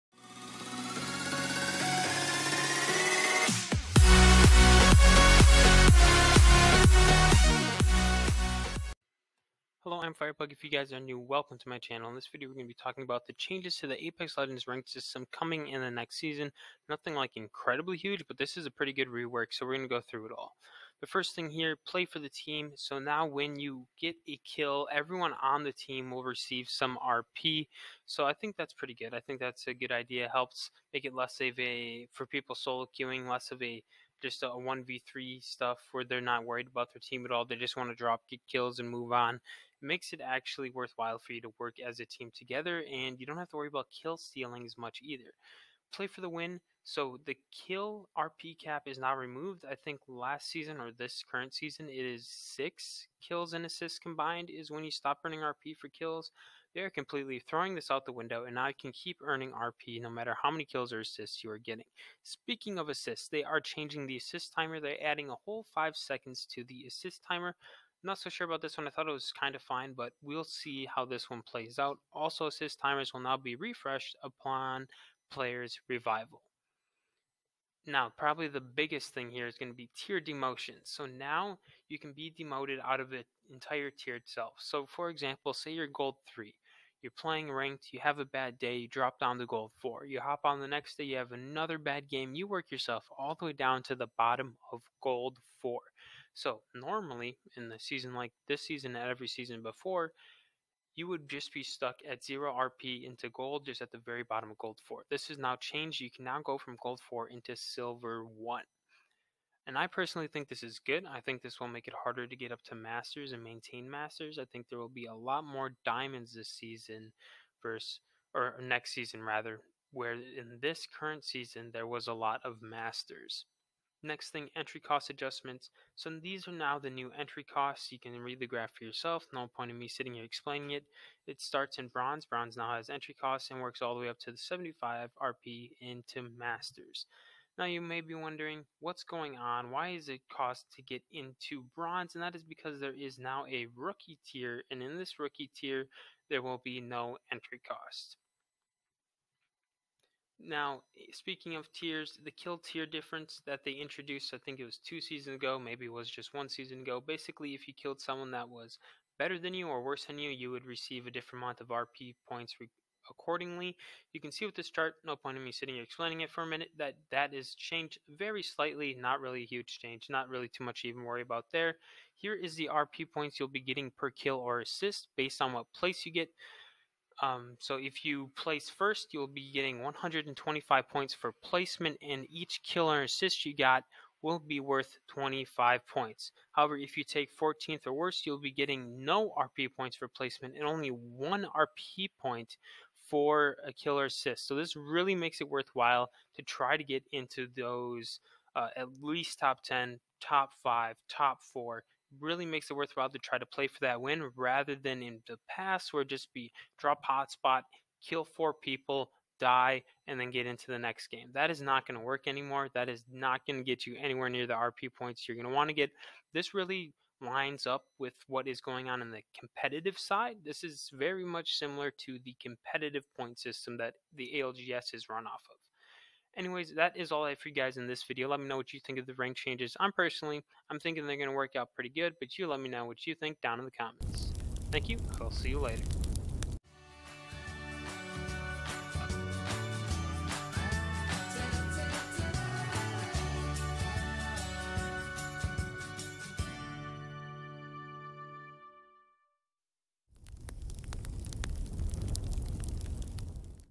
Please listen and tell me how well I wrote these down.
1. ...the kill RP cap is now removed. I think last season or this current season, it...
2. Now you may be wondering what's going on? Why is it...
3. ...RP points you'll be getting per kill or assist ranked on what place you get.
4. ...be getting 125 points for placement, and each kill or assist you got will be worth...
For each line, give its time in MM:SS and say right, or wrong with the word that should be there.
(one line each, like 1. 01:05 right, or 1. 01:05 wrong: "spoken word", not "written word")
1. 00:47 right
2. 02:17 right
3. 02:52 wrong: "based", not "ranked"
4. 02:59 right.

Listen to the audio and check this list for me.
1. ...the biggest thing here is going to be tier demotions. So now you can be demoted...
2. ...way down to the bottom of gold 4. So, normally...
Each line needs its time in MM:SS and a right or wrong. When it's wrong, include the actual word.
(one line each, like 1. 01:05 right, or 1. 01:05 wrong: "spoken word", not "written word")
1. 01:18 right
2. 01:33 right.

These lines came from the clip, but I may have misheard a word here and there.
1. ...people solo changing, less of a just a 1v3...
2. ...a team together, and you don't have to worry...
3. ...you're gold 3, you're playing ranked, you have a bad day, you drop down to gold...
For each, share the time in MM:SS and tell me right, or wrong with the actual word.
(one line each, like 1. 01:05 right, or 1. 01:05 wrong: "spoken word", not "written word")
1. 00:32 wrong: "queuing", not "changing"
2. 00:41 right
3. 01:25 right.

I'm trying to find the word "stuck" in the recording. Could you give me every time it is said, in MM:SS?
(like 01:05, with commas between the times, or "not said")
01:41.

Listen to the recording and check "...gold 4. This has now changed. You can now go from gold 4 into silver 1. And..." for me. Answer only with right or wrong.
right.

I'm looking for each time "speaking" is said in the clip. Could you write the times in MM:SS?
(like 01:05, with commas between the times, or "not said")
01:02, 02:31.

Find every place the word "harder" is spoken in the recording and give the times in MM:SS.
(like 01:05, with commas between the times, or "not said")
01:51.